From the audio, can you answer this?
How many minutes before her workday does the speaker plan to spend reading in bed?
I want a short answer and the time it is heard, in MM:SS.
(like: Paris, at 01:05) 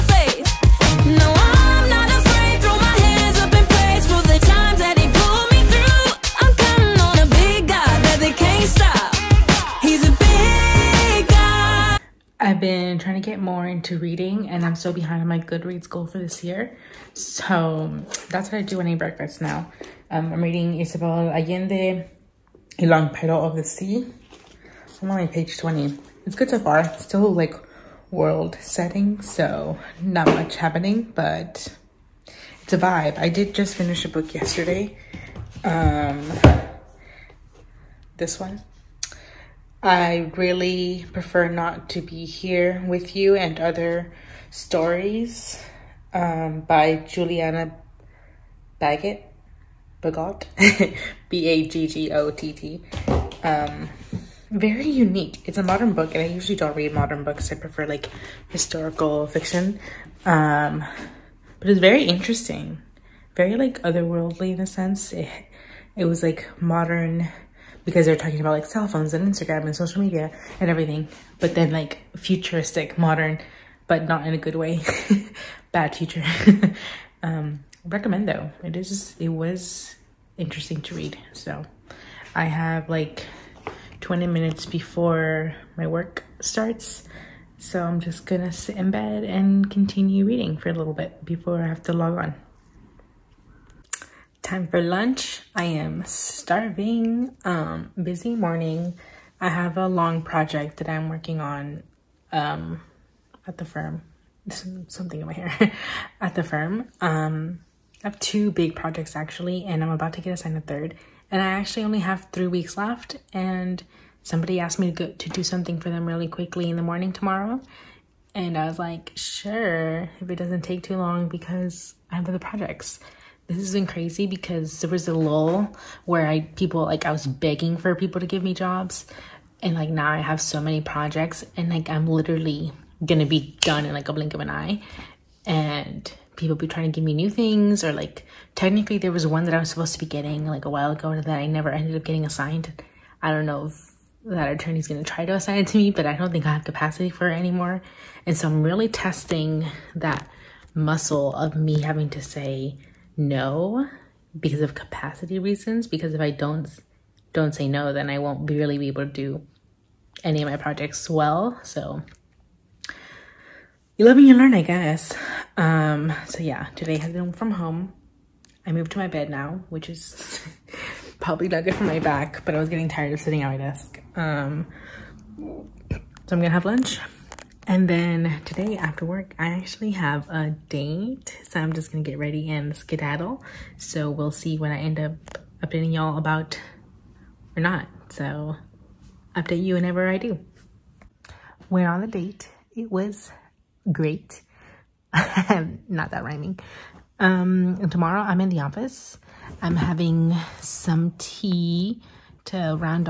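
20, at 01:24.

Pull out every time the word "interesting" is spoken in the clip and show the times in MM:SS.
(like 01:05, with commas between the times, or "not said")
01:02, 01:20.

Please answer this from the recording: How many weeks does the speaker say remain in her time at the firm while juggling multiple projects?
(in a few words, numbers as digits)
3.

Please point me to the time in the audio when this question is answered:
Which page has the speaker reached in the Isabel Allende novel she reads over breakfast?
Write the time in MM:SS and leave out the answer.
00:25.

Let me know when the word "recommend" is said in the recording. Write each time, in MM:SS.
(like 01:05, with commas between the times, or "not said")
01:17.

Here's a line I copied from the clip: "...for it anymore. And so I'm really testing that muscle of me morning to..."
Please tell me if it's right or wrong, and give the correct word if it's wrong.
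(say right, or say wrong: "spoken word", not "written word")
wrong: "having", not "morning".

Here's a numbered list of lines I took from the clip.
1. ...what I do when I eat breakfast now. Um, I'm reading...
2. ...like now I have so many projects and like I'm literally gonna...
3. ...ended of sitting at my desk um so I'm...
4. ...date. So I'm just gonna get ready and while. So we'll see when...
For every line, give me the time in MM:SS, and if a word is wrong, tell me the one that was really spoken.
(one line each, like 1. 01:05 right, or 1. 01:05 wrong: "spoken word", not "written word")
1. 00:18 right
2. 02:09 right
3. 02:52 wrong: "tired", not "ended"
4. 03:00 wrong: "skedaddle", not "while".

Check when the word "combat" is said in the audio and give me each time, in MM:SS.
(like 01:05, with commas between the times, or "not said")
not said.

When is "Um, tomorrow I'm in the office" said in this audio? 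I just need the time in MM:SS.
03:17.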